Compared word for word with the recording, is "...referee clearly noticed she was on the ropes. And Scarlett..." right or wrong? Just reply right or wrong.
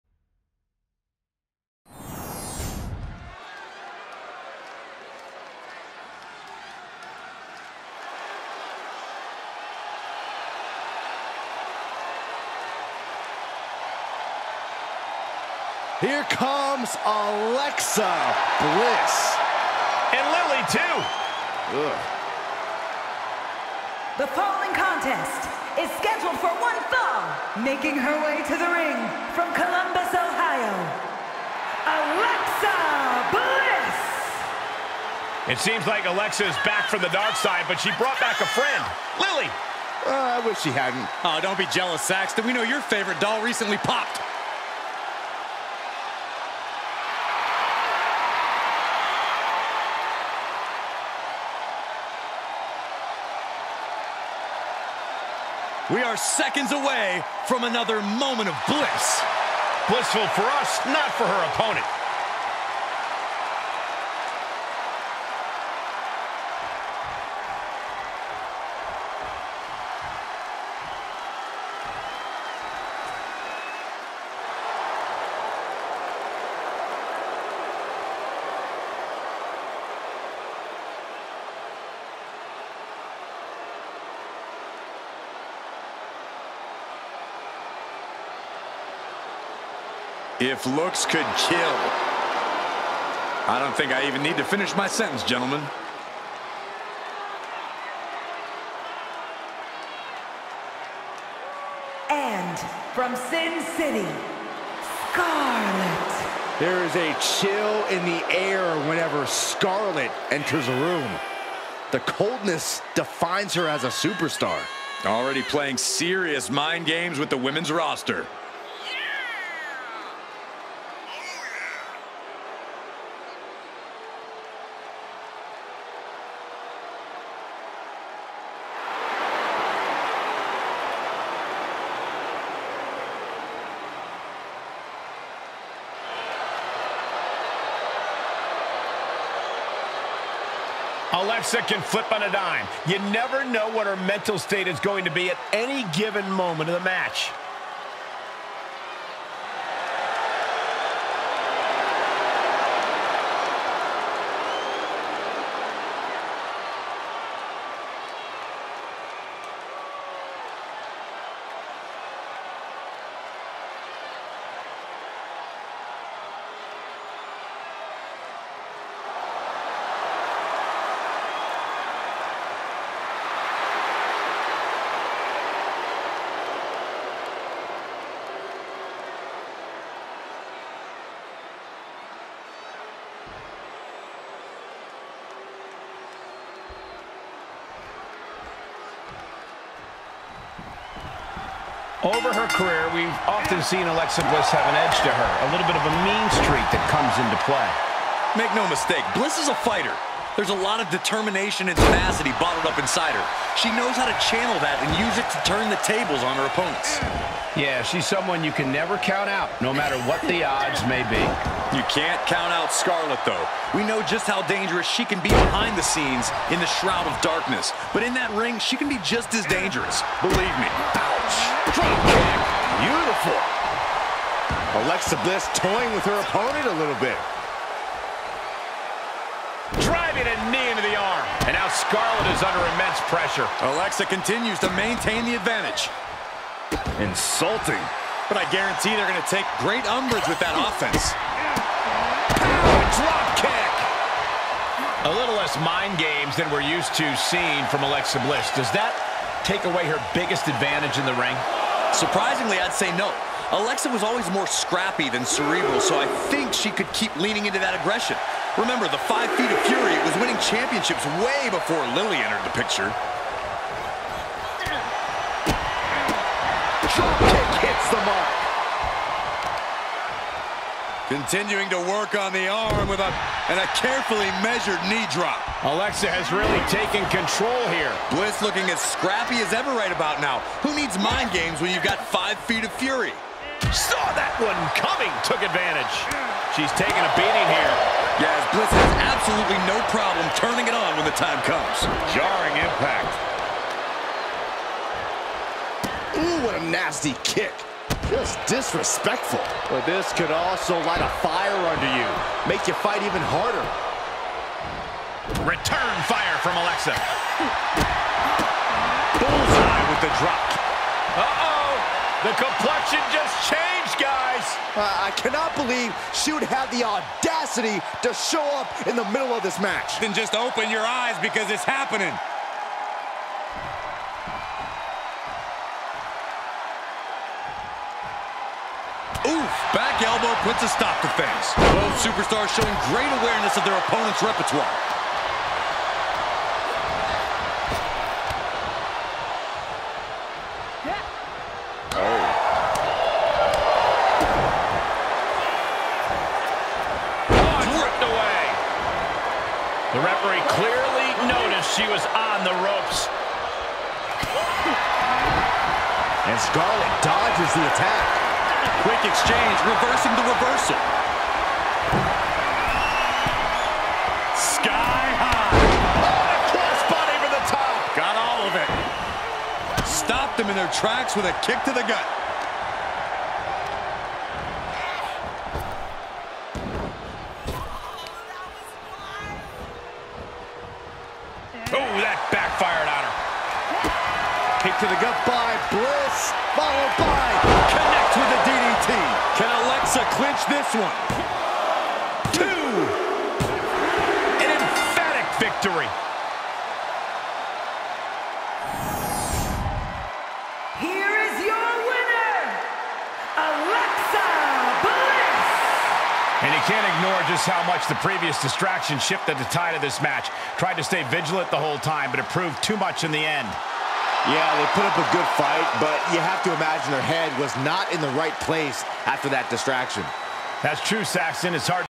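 right.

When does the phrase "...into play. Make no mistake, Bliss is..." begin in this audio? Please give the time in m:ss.
3:17.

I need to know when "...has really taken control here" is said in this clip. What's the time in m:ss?
4:36.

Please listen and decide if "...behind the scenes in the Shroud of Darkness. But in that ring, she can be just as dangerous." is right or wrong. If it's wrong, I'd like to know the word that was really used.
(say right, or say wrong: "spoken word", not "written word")
right.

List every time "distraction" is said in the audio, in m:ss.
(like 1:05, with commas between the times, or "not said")
6:48, 6:59.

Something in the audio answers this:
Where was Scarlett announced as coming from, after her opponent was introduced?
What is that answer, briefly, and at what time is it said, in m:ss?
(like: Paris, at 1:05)
Sin City, at 1:43.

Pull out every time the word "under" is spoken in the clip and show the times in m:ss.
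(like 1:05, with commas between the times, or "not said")
3:52, 5:01.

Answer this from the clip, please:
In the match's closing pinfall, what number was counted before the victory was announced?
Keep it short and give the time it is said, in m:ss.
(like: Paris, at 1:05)
2, at 6:32.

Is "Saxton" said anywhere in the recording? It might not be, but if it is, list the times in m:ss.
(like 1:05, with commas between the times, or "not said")
0:42, 7:01.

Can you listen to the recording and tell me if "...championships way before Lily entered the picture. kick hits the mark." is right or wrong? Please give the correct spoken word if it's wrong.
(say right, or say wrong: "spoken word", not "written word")
right.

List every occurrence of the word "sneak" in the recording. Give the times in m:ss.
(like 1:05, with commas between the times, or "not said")
not said.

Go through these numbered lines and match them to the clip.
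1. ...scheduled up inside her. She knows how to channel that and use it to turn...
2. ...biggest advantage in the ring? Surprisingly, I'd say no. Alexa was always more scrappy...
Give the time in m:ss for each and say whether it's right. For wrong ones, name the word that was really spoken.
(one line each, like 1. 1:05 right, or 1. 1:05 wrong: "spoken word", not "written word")
1. 3:22 wrong: "bottled", not "scheduled"
2. 4:10 right.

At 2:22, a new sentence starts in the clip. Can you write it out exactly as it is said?
You never know what her mental state is going to be at any given moment of the match.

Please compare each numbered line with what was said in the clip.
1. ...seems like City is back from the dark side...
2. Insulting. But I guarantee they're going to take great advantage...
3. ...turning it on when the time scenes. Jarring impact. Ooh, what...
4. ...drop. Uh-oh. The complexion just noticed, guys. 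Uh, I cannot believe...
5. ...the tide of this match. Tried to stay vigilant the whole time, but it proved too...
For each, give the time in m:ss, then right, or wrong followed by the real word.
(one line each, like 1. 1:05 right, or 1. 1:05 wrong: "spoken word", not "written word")
1. 0:35 wrong: "Alexa", not "City"
2. 3:56 wrong: "umbrage", not "advantage"
3. 4:50 wrong: "comes", not "scenes"
4. 5:10 wrong: "changed", not "noticed"
5. 6:49 right.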